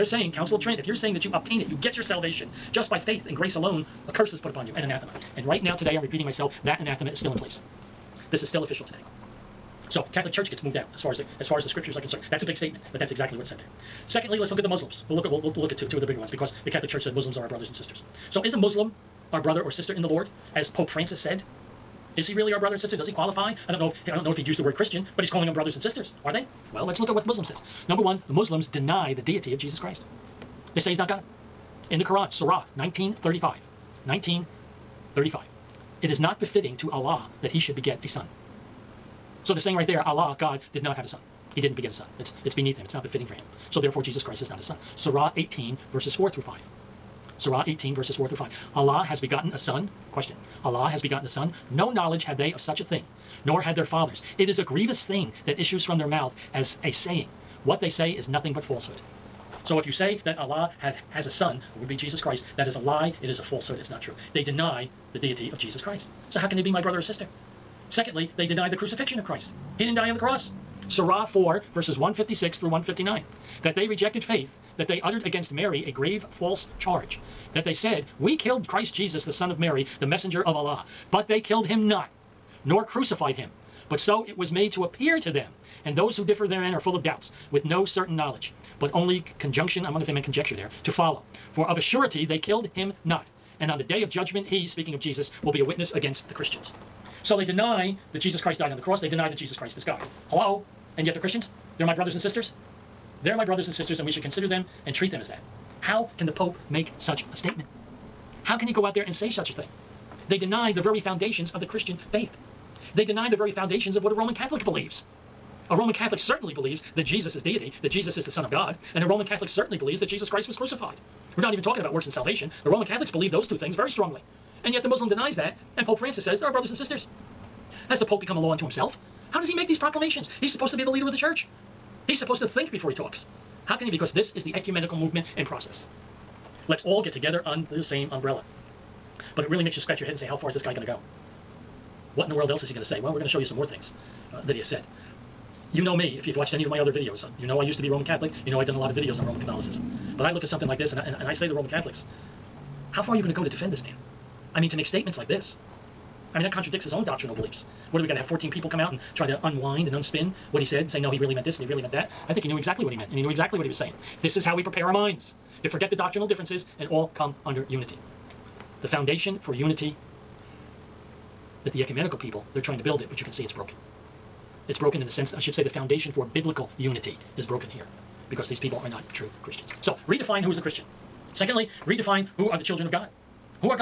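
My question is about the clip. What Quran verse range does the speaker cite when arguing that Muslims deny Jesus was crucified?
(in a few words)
156 through 159.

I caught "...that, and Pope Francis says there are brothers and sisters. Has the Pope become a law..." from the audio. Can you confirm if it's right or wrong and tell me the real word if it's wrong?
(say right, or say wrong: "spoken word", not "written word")
right.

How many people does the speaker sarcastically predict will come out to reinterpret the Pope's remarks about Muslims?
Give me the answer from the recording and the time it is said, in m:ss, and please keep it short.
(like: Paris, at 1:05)
14, at 2:38.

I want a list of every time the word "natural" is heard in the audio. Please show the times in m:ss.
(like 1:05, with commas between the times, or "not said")
not said.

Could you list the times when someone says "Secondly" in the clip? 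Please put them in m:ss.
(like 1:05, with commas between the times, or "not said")
0:14, 1:07, 3:01.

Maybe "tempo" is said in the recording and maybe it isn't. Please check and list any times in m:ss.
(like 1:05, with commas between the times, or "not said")
not said.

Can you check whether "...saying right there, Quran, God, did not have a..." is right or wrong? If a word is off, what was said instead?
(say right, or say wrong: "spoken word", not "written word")
wrong: "Allah", not "Quran".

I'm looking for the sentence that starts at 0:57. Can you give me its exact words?
What they say is nothing but falsehood.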